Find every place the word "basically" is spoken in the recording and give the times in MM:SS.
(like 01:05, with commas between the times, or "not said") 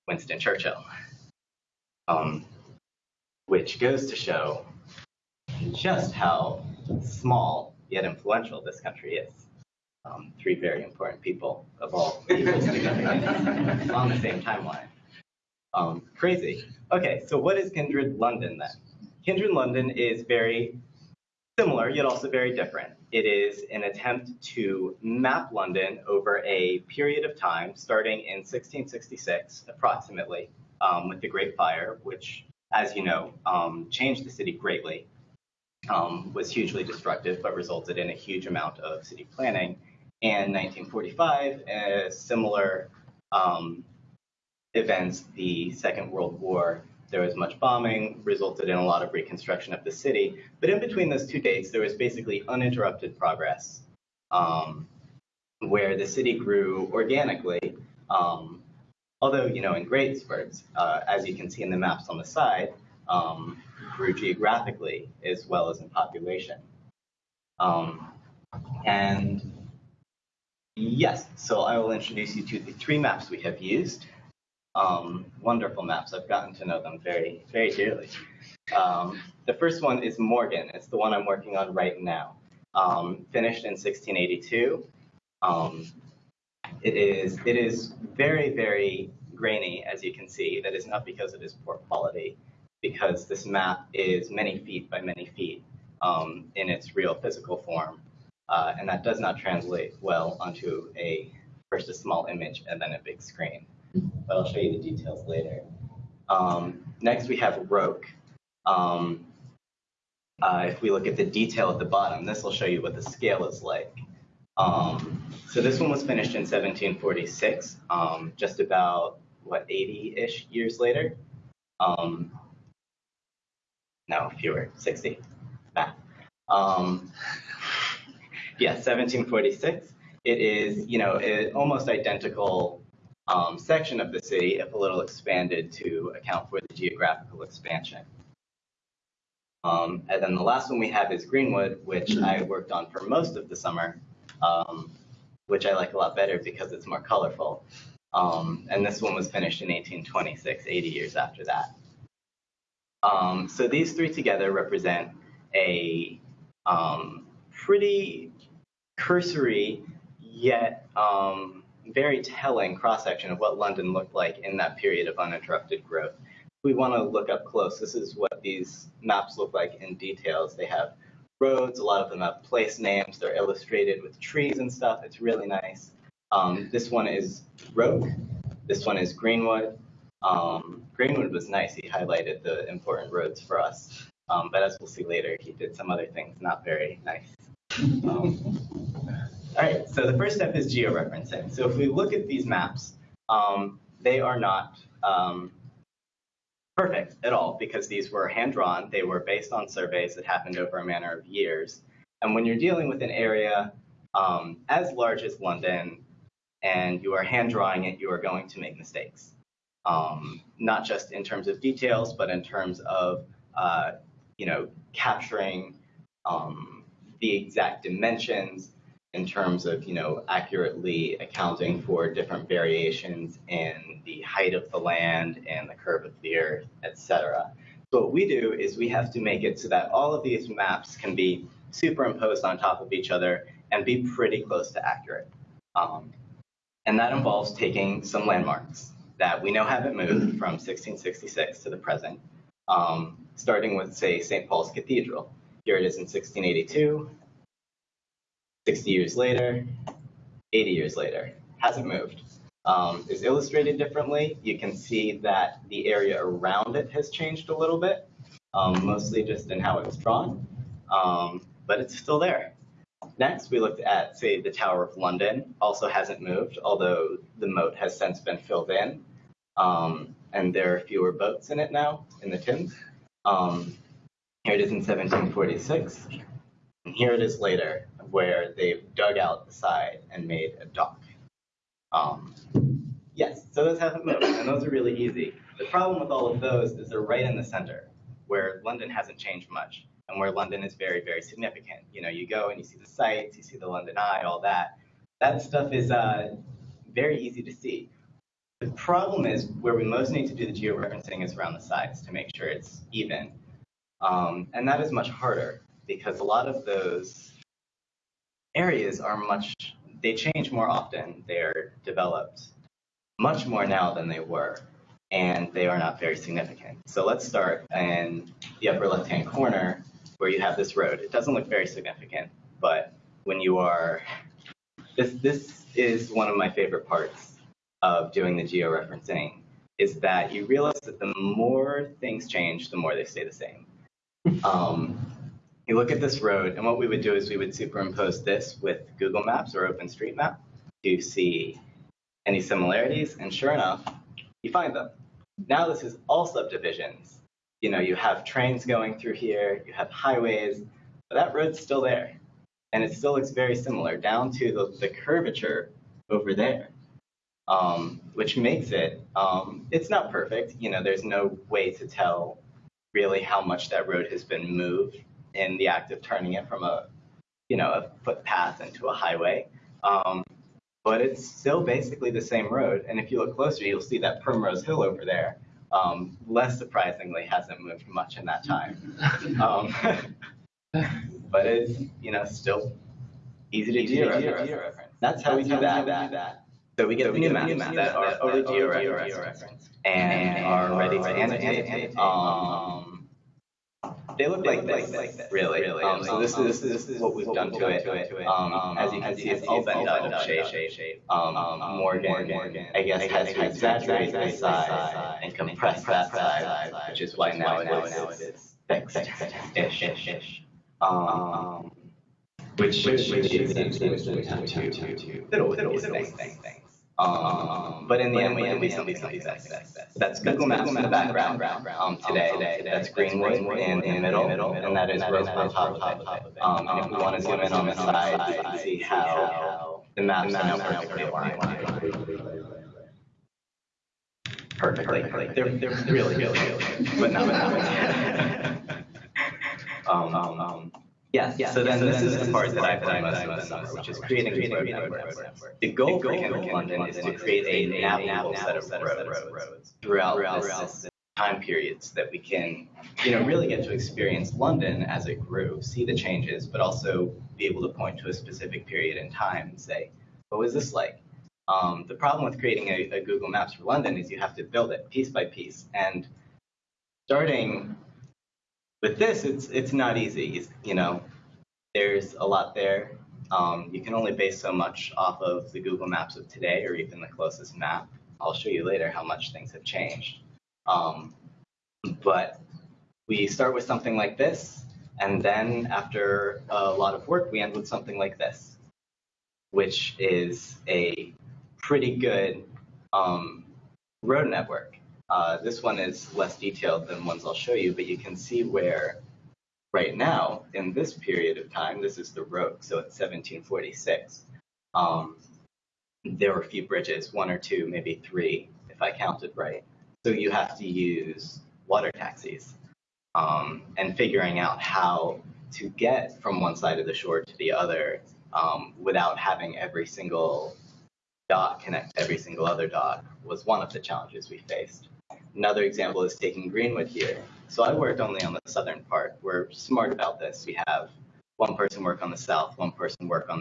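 00:51, 06:11.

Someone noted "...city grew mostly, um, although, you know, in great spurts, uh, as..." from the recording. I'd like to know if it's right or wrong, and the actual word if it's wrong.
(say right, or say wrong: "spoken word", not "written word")
wrong: "organically", not "mostly".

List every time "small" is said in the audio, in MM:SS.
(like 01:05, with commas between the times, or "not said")
00:07, 01:41.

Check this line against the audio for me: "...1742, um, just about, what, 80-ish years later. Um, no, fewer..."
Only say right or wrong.
wrong.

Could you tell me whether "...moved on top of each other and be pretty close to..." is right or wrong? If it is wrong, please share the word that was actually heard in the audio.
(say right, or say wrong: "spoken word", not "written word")
wrong: "superimposed", not "moved".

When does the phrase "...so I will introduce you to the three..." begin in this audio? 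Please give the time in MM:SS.
01:11.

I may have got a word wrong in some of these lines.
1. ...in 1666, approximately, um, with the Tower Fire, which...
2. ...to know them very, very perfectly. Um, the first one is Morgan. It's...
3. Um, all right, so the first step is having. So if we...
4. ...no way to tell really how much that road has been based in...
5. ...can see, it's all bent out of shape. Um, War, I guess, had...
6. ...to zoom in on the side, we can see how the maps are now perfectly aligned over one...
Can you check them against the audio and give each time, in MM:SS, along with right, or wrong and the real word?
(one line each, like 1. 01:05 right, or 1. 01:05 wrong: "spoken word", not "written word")
1. 00:28 wrong: "Great", not "Tower"
2. 01:16 wrong: "dearly", not "perfectly"
3. 03:07 wrong: "georeferencing", not "having"
4. 06:01 wrong: "moved", not "based"
5. 06:39 wrong: "Morgan", not "War"
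6. 07:07 right.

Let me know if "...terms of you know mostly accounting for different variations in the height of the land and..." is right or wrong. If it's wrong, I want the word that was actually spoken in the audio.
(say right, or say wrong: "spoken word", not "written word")
wrong: "accurately", not "mostly".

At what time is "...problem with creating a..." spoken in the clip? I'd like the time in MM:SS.
07:41.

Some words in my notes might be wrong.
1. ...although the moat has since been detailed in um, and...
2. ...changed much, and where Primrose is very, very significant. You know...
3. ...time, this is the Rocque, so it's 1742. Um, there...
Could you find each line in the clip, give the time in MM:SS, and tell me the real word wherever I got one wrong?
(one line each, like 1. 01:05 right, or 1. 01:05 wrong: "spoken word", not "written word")
1. 04:26 wrong: "filled", not "detailed"
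2. 04:49 wrong: "London", not "Primrose"
3. 08:21 wrong: "1746", not "1742".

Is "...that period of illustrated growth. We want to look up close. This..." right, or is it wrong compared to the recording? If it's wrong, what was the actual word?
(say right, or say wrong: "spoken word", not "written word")
wrong: "uninterrupted", not "illustrated".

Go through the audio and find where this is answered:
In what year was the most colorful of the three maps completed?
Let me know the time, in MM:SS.
02:29.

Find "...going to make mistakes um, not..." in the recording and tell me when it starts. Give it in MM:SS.
03:28.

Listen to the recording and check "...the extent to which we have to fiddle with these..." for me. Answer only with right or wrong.
right.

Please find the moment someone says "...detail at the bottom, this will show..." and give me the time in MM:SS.
01:51.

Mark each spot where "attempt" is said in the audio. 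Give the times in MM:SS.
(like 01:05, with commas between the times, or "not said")
00:23.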